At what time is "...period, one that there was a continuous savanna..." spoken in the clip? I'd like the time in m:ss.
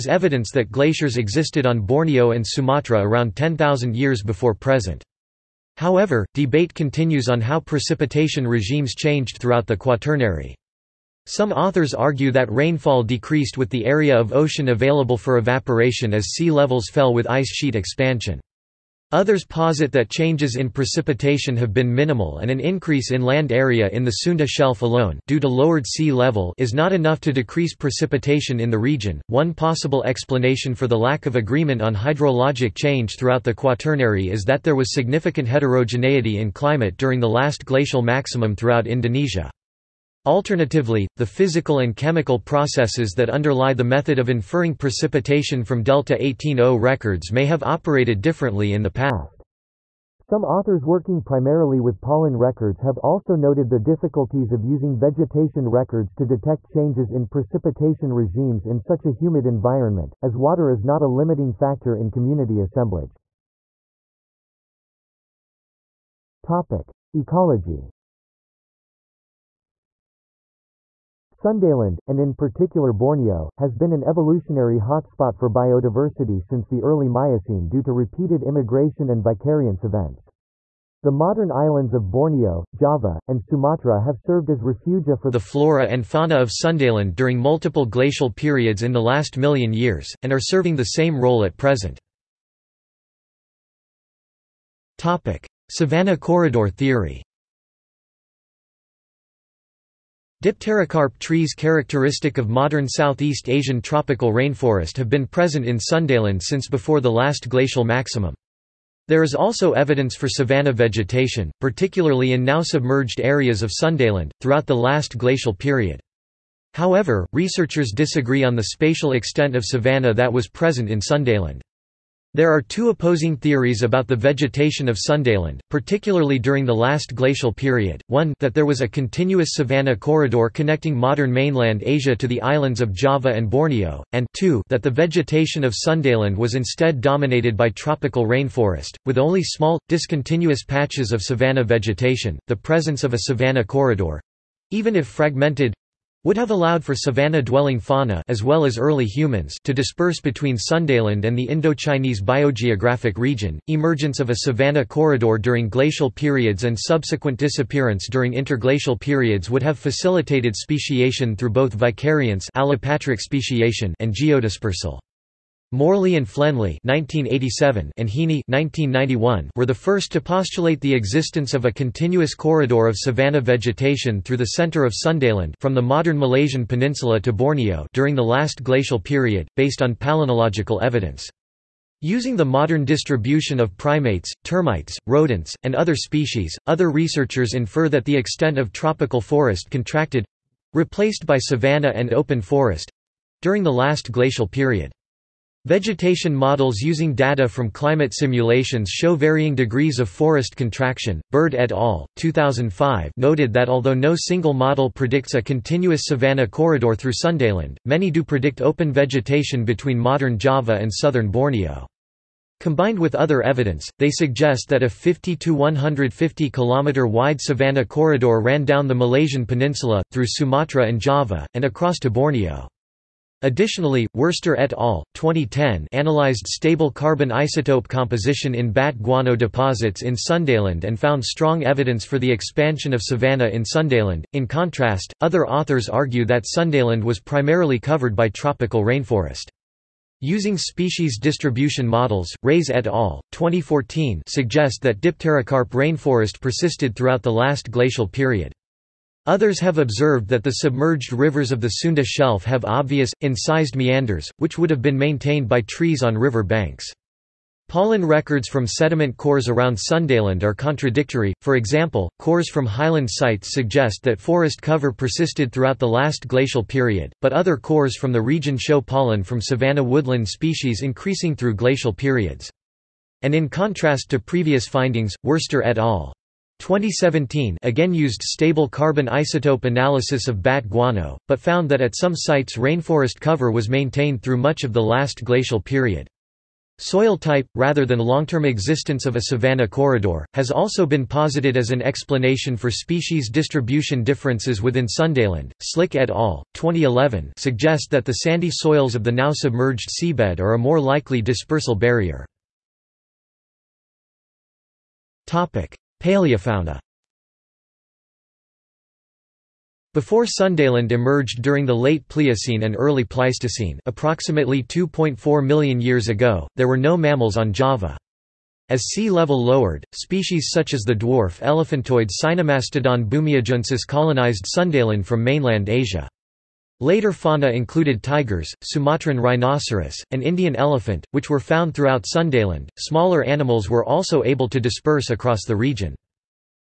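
2:07.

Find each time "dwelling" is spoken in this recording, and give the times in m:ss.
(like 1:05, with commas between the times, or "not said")
2:26.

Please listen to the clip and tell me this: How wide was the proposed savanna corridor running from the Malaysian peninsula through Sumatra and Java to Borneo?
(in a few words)
50 to 150 km.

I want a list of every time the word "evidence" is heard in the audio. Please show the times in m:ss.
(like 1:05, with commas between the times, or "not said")
0:00, 1:49, 3:00, 3:33, 3:51.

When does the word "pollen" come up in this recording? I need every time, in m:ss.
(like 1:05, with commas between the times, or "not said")
0:52, 4:17, 4:28.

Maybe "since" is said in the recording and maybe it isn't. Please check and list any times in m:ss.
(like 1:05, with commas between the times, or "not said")
1:16, 1:46.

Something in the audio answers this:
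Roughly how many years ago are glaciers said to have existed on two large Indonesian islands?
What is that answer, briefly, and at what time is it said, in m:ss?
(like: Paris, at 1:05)
10,000, at 0:03.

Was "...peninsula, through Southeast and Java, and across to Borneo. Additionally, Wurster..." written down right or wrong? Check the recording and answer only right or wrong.
wrong.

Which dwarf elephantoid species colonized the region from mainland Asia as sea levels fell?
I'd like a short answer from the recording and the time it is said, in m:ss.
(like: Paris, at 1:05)
Sinomastodon bumiajuensis, at 5:22.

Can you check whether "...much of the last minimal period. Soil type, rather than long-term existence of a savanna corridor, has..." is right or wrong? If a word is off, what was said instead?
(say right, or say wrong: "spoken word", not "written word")
wrong: "glacial", not "minimal".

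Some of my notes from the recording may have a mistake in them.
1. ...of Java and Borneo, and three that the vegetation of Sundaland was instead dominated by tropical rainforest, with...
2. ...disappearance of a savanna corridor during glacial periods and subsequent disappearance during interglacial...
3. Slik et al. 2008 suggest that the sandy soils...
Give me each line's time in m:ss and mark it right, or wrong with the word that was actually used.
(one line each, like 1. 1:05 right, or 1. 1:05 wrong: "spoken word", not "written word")
1. 2:12 wrong: "two", not "three"
2. 2:33 wrong: "emergence", not "disappearance"
3. 4:55 wrong: "2011", not "2008".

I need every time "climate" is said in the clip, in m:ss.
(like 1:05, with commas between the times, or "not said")
0:36, 3:17.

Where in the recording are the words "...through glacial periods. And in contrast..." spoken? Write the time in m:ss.
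4:31.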